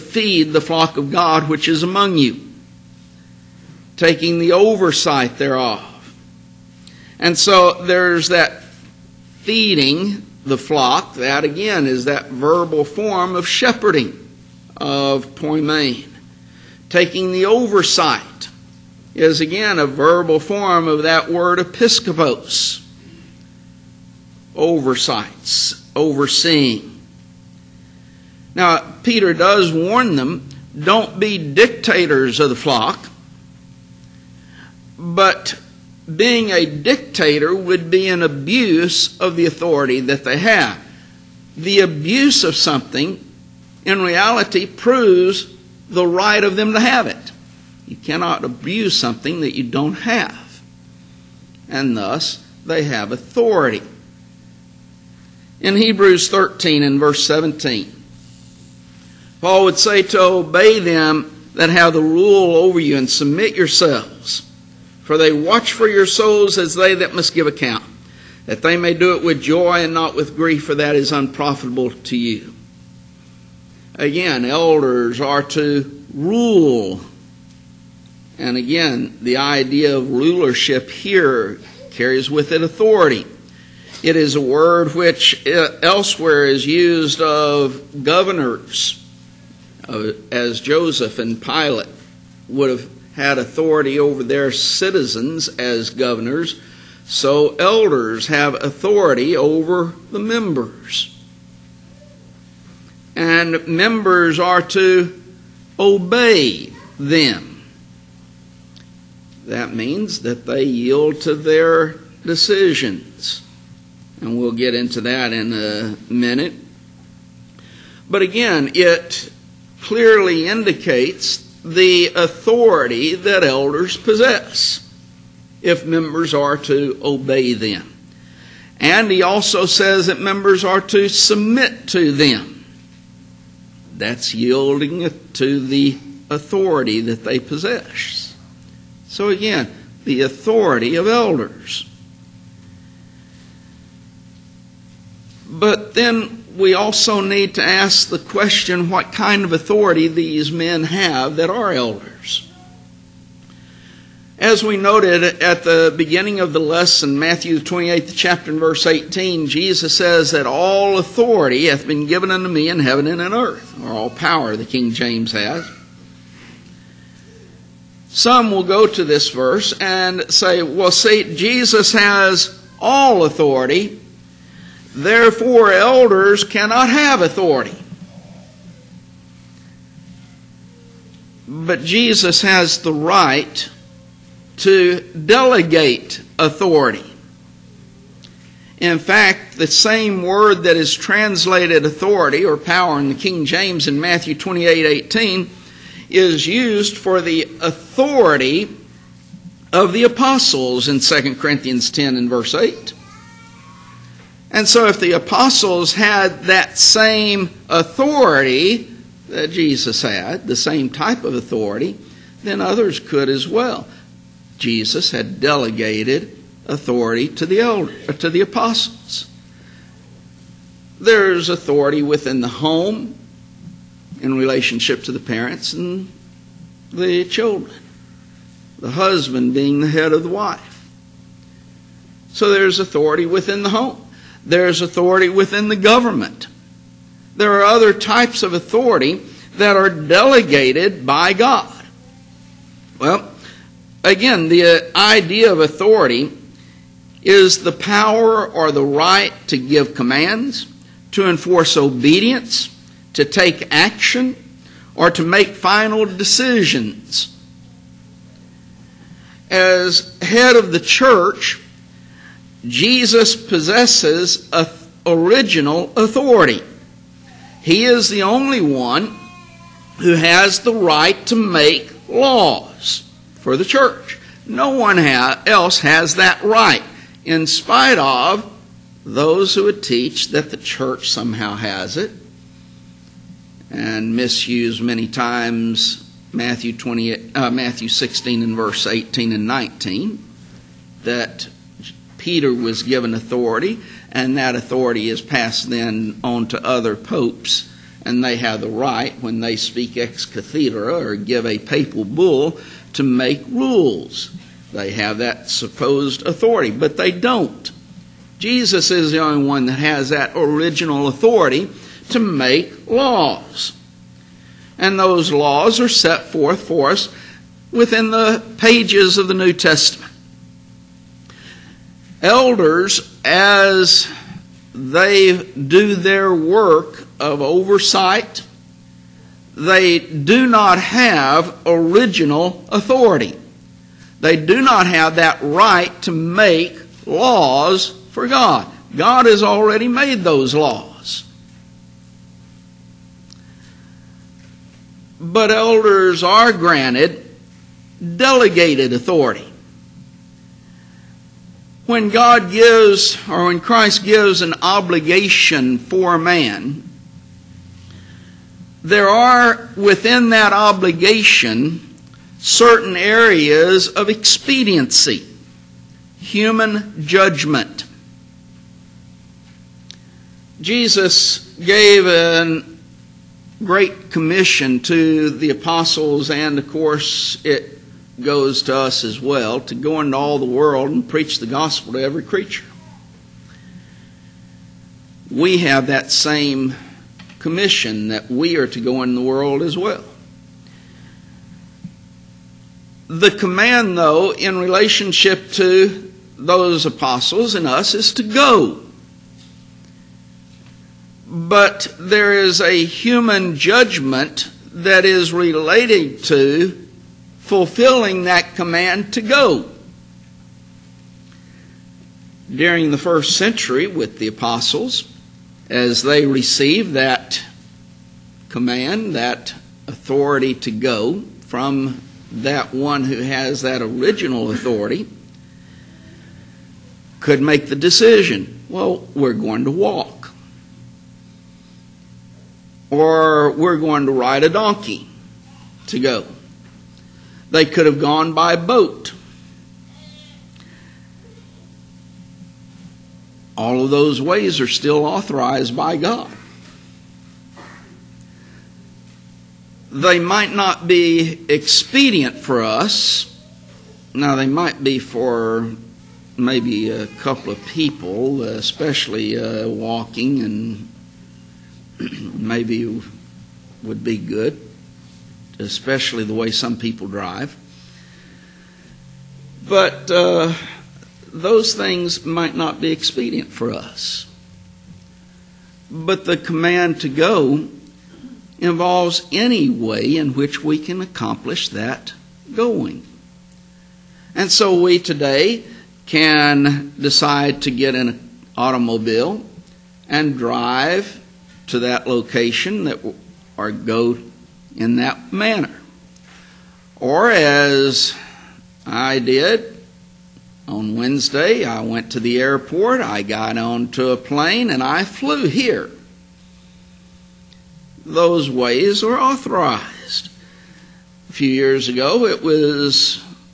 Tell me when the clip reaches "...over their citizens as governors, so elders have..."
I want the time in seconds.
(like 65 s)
93 s.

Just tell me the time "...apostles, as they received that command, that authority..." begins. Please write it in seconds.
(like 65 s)
414 s.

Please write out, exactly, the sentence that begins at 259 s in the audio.
As head of the church, Jesus possesses original authority.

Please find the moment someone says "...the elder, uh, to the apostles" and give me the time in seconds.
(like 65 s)
217 s.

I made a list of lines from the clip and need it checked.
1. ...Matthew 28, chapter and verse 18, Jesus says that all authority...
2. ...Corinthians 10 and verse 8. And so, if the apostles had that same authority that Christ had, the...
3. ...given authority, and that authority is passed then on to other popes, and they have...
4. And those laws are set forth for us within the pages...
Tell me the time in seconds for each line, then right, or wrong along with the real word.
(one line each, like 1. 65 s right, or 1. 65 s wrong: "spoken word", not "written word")
1. 157 s right
2. 201 s wrong: "Jesus", not "Christ"
3. 292 s right
4. 314 s right.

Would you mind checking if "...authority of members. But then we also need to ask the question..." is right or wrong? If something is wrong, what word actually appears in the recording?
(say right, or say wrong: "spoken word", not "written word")
wrong: "elders", not "members".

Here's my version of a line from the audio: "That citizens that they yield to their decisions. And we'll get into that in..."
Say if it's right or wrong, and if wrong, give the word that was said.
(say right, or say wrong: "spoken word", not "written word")
wrong: "means", not "citizens".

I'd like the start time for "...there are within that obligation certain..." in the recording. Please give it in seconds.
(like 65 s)
358 s.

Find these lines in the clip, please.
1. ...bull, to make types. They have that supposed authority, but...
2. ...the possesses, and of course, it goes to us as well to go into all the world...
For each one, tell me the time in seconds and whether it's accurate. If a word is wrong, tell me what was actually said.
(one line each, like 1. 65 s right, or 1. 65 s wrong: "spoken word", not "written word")
1. 302 s wrong: "rules", not "types"
2. 375 s wrong: "apostles", not "possesses".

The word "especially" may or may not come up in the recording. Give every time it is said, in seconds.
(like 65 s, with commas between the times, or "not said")
458 s, 465 s.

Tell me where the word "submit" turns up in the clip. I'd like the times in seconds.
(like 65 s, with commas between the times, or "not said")
63 s, 131 s.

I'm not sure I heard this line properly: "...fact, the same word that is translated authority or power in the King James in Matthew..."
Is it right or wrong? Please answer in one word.
right.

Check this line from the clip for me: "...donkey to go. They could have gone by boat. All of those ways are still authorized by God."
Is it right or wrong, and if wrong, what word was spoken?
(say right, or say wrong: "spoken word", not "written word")
right.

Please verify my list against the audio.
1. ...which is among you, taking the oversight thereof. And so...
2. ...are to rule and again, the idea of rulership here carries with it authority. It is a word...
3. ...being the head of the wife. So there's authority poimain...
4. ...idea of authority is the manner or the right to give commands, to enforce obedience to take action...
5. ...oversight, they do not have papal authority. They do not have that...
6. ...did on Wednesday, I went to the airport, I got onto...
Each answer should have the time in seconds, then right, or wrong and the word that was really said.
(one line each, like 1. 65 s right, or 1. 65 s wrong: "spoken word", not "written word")
1. 1 s right
2. 75 s right
3. 229 s wrong: "within", not "poimain"
4. 244 s wrong: "power", not "manner"
5. 327 s wrong: "original", not "papal"
6. 499 s right.